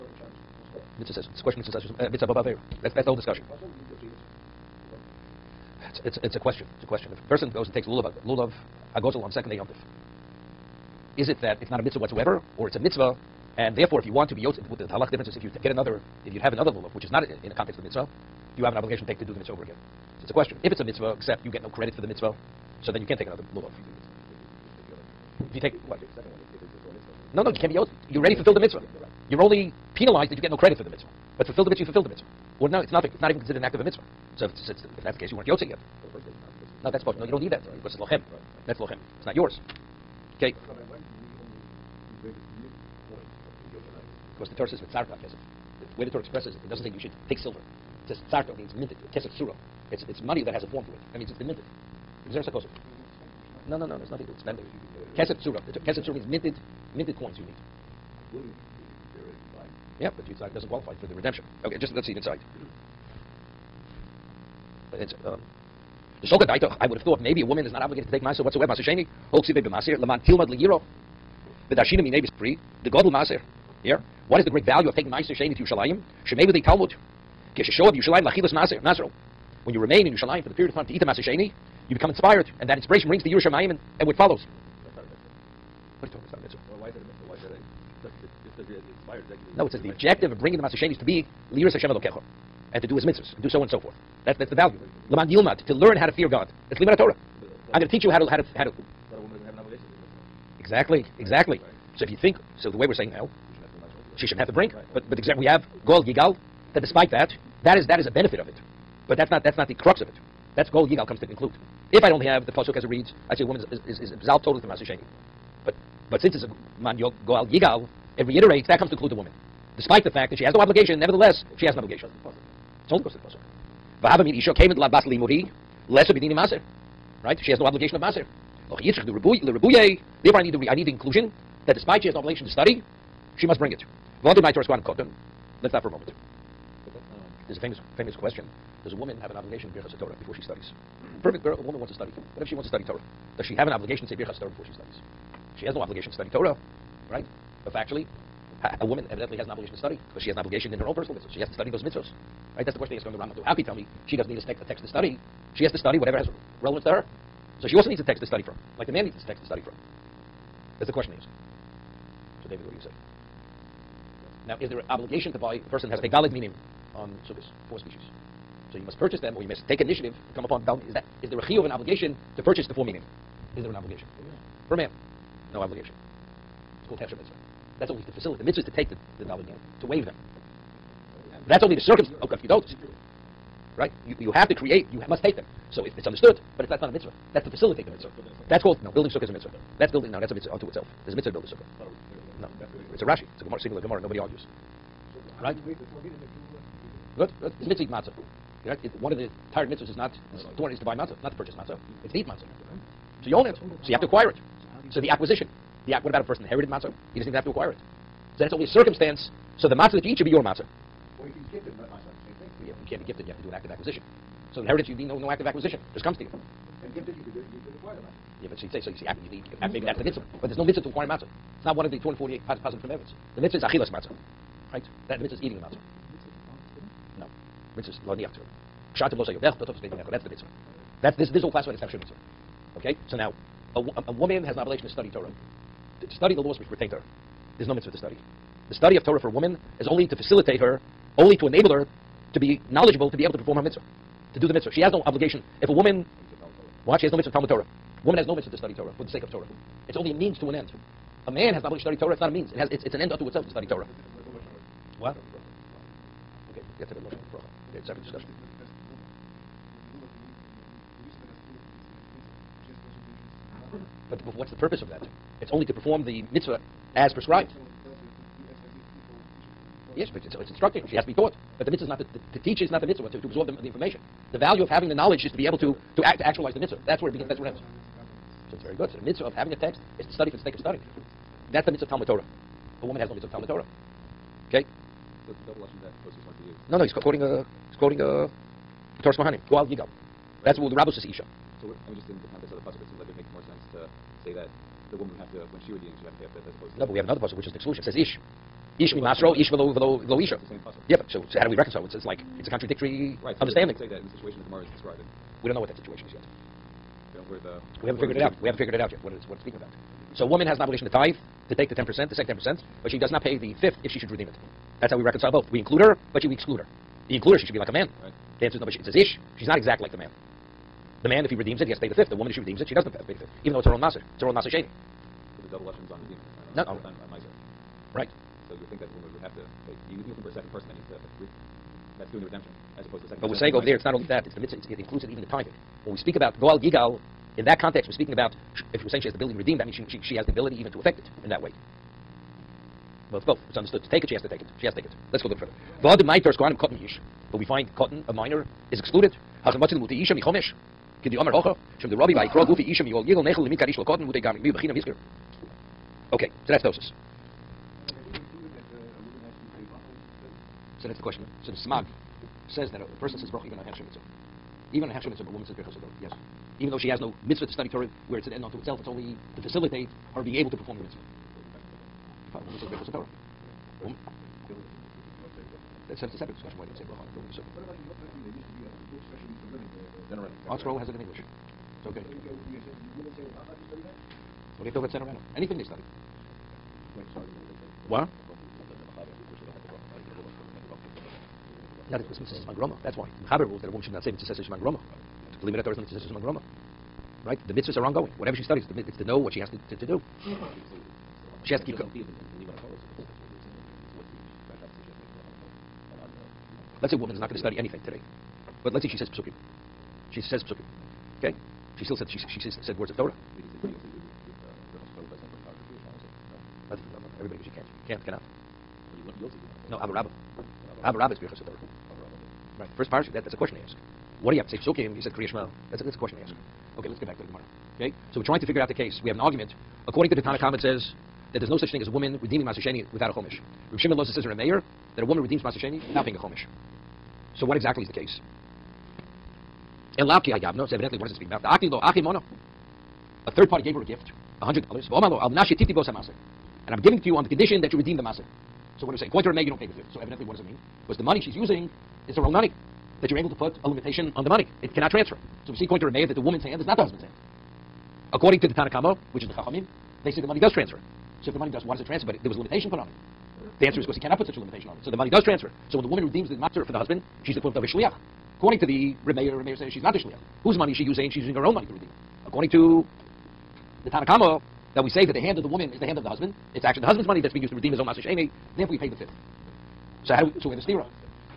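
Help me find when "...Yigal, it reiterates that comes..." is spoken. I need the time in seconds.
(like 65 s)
117 s.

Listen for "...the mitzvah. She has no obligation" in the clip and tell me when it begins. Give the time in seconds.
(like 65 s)
244 s.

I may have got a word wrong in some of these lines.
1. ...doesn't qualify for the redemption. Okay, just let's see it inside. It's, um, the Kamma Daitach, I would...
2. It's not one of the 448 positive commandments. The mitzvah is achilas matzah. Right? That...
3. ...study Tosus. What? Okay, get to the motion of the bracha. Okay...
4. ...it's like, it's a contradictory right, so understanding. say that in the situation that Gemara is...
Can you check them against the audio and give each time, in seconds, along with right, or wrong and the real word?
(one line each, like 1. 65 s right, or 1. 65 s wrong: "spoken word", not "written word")
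1. 60 s wrong: "Soka", not "Kamma"
2. 221 s wrong: "248", not "448"
3. 253 s wrong: "Torah", not "Tosus"
4. 301 s right.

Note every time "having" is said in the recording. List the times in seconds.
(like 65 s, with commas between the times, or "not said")
274 s, 279 s.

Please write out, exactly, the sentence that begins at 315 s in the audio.
We include her, but she, we exclude her.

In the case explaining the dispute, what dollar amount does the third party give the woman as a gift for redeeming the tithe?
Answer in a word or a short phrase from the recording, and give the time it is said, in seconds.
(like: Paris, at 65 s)
$100, at 444 s.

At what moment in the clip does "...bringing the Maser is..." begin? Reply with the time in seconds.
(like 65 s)
90 s.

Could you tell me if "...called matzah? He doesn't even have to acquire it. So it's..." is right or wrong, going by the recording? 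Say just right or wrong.
wrong.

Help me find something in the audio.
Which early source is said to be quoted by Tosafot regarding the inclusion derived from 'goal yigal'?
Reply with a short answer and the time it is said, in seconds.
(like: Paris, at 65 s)
Toras Kohanim, at 289 s.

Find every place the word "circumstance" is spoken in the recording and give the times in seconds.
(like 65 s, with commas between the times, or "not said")
181 s, 208 s.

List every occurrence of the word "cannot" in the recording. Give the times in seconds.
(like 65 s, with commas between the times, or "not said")
418 s, 454 s, 463 s.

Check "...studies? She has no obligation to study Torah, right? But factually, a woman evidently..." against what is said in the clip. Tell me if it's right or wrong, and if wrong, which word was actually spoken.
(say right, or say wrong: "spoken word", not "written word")
right.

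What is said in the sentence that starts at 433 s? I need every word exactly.
Rav Shimon Loza says in a mayor that a woman redeems Master without paying a Chomish.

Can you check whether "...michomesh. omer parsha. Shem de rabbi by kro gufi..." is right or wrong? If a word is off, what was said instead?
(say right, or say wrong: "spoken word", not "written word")
wrong: "hocha", not "parsha".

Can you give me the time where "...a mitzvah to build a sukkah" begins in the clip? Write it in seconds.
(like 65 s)
191 s.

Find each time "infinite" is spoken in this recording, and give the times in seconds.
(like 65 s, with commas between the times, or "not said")
not said.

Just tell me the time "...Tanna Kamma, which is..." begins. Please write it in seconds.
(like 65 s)
458 s.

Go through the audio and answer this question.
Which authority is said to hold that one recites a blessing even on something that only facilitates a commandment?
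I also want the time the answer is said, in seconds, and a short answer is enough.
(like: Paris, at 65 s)
the smag, at 361 s.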